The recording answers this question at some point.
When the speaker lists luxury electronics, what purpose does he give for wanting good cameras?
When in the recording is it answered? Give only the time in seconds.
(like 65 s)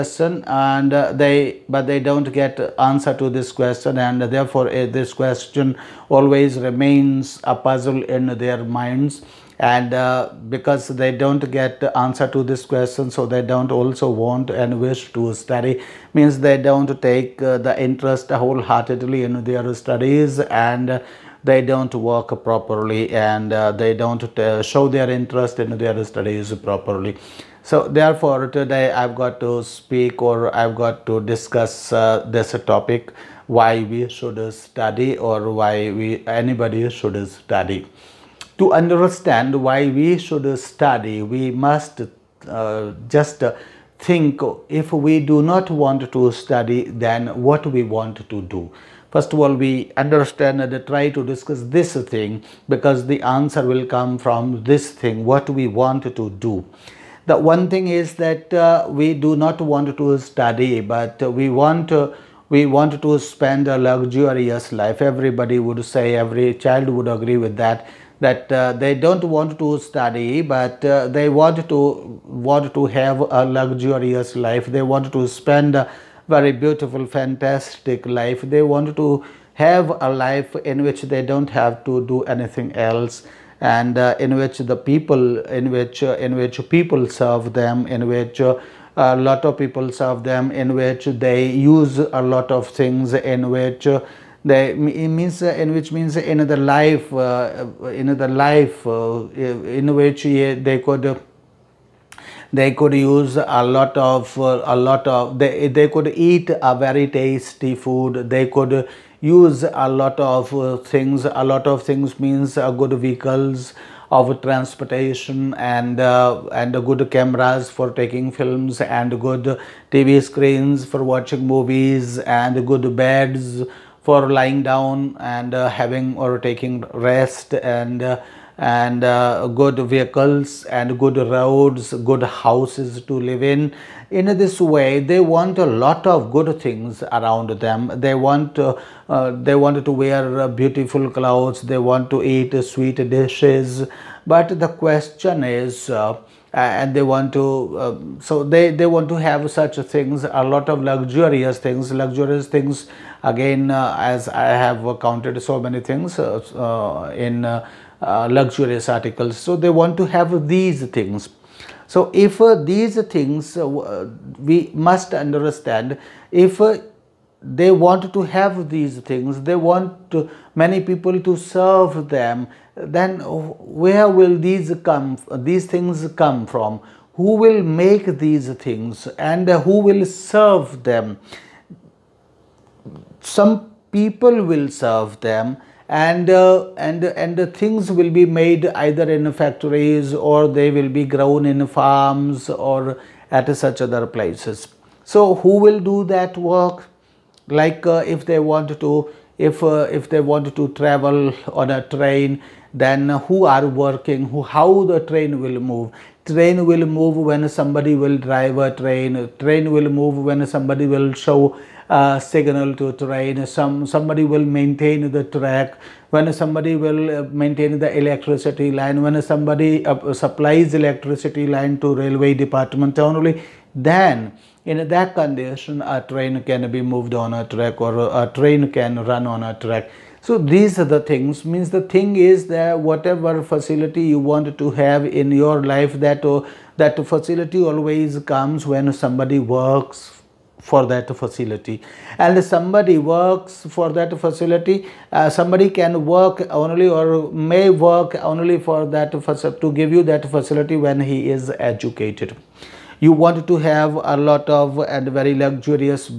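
117 s.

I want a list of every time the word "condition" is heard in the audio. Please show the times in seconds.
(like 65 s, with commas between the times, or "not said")
225 s.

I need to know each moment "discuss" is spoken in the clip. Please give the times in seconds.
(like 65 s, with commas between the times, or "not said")
31 s, 51 s.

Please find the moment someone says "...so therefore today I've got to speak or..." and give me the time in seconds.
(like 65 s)
27 s.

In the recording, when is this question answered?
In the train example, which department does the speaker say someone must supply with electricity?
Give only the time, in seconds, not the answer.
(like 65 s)
221 s.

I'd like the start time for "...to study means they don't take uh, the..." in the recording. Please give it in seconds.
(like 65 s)
15 s.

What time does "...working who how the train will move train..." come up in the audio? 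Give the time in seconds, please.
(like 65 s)
203 s.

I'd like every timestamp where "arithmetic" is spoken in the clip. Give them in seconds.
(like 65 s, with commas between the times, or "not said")
not said.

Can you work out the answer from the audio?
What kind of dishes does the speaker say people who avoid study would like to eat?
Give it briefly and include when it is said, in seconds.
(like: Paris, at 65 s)
Sweet dishes, at 142 s.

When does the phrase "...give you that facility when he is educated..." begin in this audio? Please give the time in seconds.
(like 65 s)
249 s.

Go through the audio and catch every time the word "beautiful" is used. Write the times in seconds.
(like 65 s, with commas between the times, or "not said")
76 s, 140 s.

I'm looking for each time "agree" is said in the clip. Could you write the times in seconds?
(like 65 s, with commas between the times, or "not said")
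67 s.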